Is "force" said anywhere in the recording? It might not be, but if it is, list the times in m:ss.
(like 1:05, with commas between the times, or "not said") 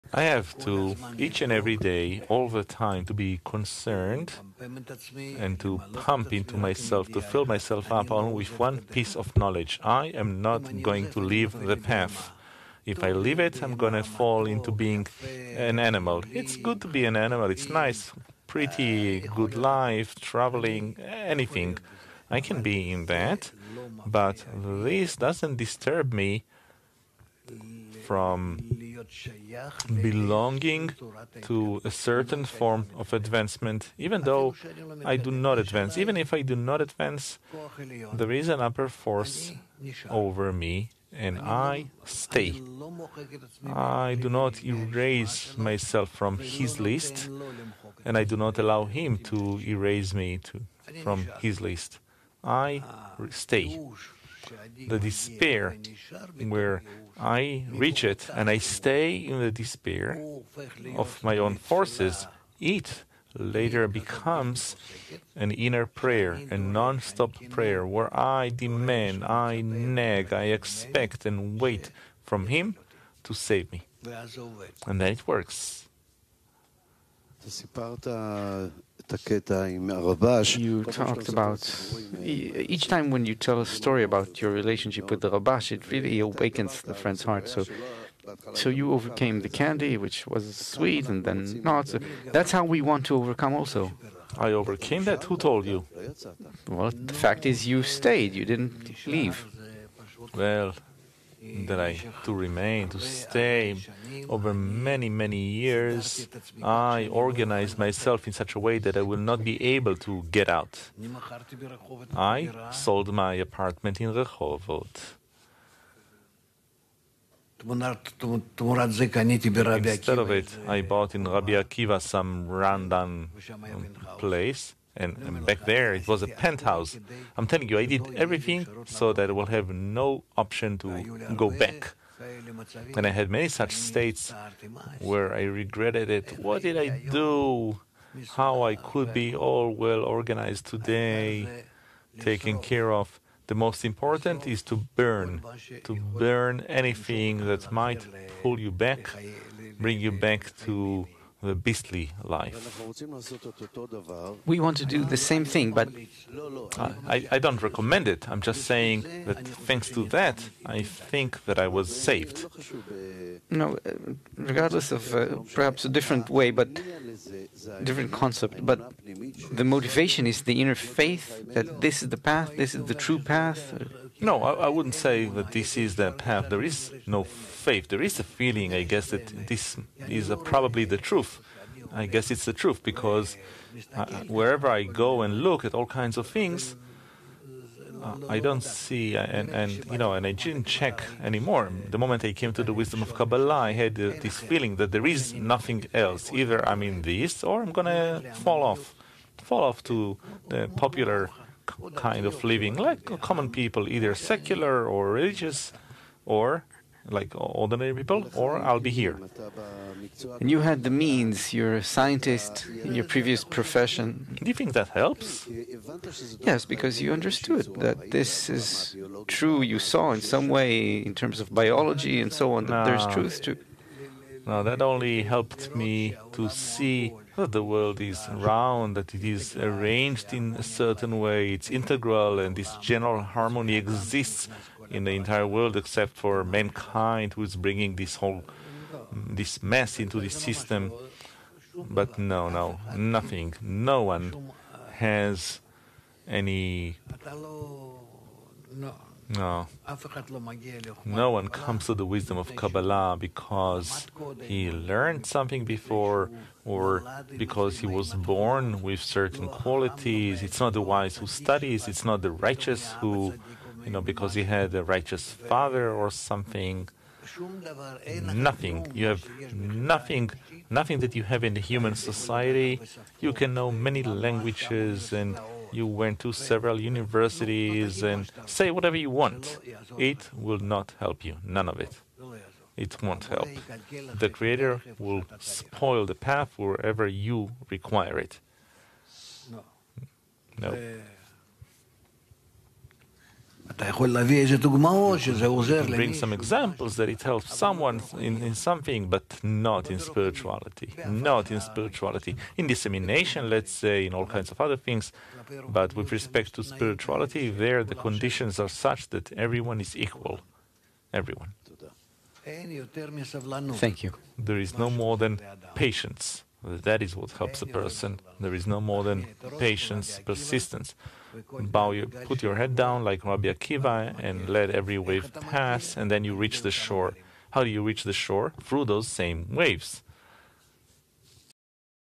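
0:38, 1:01.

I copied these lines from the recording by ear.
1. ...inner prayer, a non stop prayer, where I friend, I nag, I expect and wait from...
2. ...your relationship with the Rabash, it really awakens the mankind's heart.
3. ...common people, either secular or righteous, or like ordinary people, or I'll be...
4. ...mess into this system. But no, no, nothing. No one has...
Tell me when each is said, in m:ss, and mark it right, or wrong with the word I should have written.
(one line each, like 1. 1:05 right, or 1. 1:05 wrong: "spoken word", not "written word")
1. 1:05 wrong: "demand", not "friend"
2. 1:24 wrong: "friend", not "mankind"
3. 3:23 wrong: "religious", not "righteous"
4. 3:59 right.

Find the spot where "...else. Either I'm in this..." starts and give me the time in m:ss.
3:15.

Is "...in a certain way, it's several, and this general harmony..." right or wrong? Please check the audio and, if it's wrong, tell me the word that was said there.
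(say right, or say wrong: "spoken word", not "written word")
wrong: "integral", not "several".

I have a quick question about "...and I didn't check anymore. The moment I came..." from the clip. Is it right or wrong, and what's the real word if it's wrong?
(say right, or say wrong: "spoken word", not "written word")
right.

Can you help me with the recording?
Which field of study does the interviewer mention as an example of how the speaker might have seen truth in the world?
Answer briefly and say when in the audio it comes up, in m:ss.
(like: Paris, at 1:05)
Biology, at 3:41.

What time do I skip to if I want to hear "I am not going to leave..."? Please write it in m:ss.
0:09.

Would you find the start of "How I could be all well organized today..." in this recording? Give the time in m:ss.
2:18.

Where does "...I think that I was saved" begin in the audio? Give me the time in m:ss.
2:40.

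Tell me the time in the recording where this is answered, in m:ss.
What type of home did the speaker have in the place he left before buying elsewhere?
2:06.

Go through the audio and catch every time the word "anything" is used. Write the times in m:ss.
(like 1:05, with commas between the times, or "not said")
0:20, 2:26.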